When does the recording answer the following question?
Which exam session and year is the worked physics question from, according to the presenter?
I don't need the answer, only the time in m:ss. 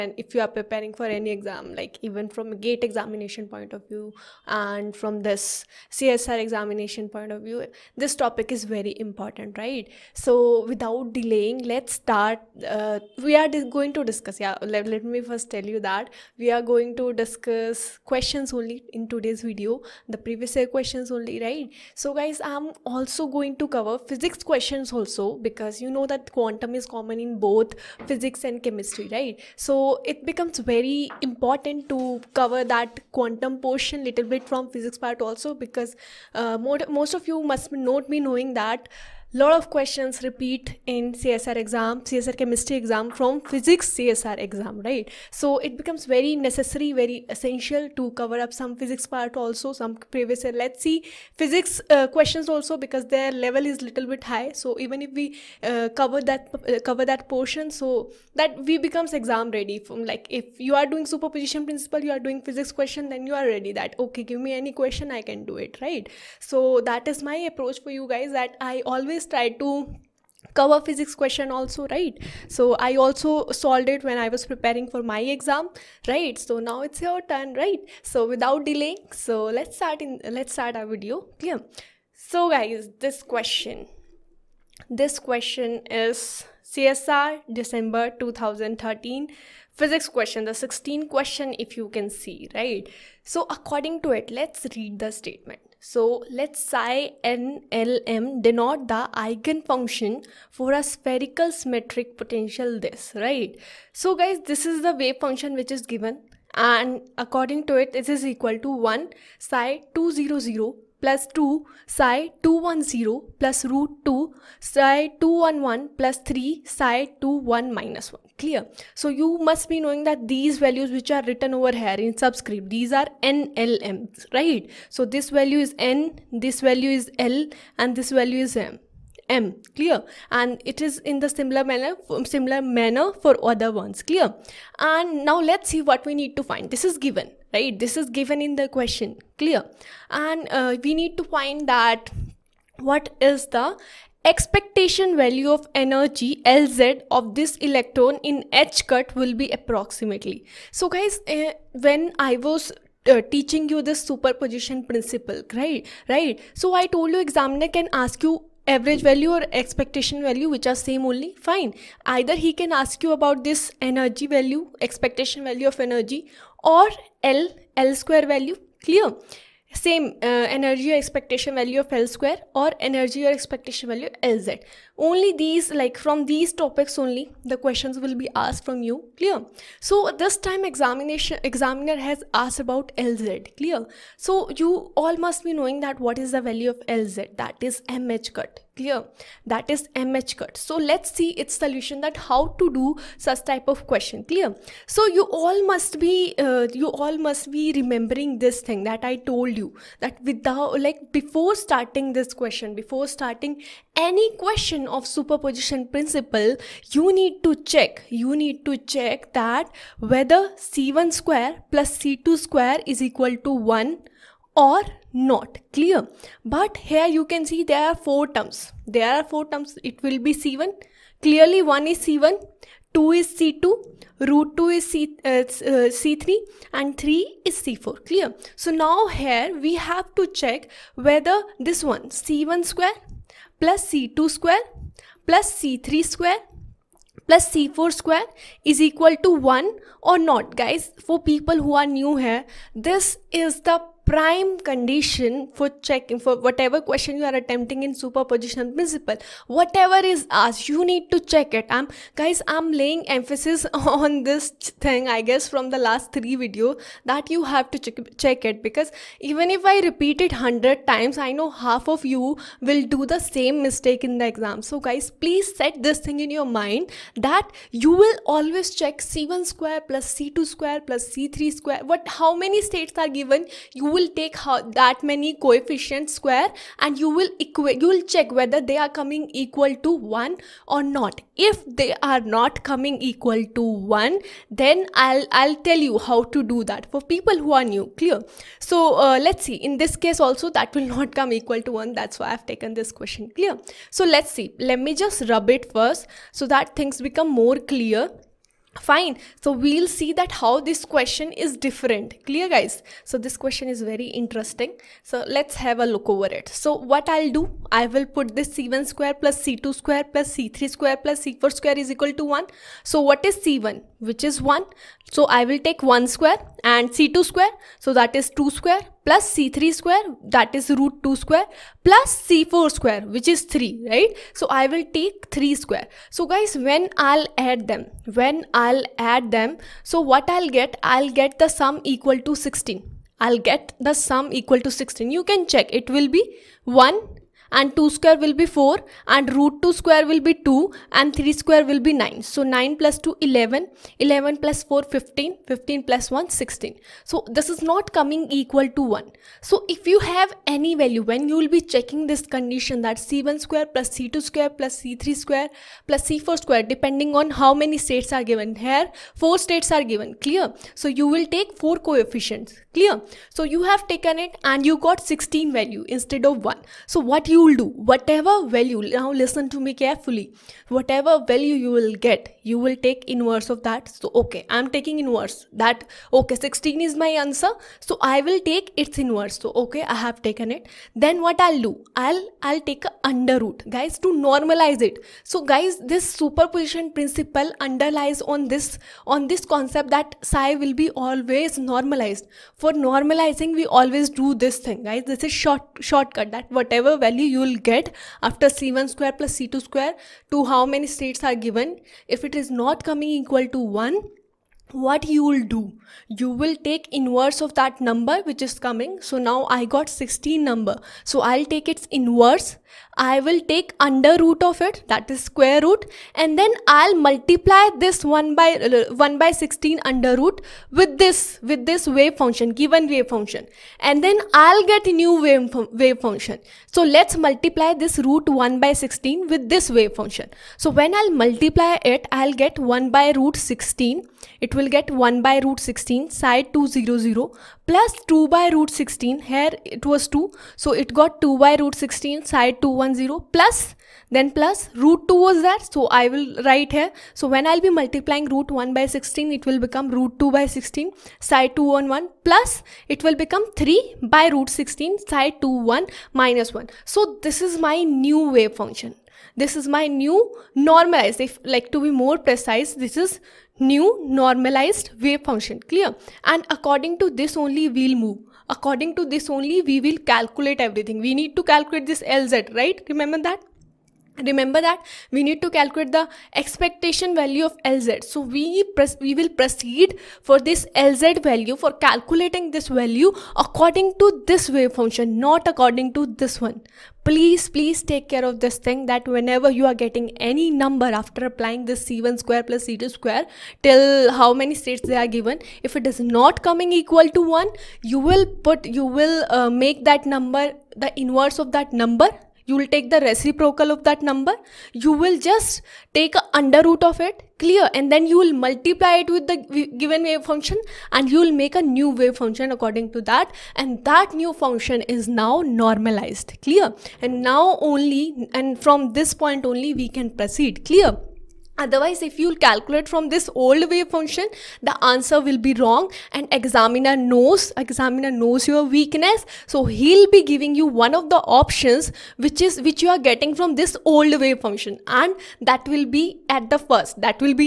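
1:26.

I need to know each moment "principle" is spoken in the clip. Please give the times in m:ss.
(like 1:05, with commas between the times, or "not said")
1:01, 2:34, 3:25, 4:08, 6:26.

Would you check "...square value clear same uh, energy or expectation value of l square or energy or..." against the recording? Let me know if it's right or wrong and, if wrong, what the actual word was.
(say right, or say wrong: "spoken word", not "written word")
right.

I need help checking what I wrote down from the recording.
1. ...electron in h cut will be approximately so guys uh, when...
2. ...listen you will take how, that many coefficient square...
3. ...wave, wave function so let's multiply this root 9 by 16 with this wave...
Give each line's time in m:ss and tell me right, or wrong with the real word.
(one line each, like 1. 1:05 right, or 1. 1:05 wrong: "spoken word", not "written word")
1. 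2:27 right
2. 4:33 wrong: "given", not "listen"
3. 7:05 wrong: "1", not "9".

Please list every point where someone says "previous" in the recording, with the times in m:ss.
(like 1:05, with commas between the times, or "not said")
0:20, 0:50.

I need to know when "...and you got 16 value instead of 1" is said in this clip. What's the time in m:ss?
6:04.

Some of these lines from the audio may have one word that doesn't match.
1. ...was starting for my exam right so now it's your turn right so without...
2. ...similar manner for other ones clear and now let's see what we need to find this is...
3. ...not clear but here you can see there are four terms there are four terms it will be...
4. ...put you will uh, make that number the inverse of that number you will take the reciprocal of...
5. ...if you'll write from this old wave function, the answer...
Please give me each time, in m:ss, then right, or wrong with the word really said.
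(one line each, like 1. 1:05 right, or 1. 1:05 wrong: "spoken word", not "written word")
1. 1:14 wrong: "preparing", not "starting"
2. 2:12 right
3. 3:35 right
4. 8:18 right
5. 8:42 wrong: "calculate", not "write".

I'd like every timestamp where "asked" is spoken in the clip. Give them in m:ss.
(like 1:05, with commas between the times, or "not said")
2:58, 3:02, 4:10.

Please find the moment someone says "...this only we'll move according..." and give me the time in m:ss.
7:47.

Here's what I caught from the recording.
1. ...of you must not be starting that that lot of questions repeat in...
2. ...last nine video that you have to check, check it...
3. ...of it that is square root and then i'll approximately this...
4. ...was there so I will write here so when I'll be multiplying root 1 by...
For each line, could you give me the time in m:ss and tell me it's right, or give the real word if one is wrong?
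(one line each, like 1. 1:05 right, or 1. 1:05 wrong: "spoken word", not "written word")
1. 0:37 wrong: "knowing", not "starting"
2. 4:15 wrong: "three", not "nine"
3. 6:54 wrong: "multiply", not "approximately"
4. 7:25 right.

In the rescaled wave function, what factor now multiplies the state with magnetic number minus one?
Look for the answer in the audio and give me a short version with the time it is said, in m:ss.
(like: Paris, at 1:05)
3 by root 16, at 7:33.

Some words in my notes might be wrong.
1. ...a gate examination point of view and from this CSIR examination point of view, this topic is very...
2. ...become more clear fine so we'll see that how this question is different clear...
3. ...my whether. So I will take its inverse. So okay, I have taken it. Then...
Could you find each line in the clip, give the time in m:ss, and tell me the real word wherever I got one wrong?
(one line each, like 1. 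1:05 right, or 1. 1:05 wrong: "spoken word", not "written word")
1. 0:02 right
2. 4:57 right
3. 6:16 wrong: "answer", not "whether".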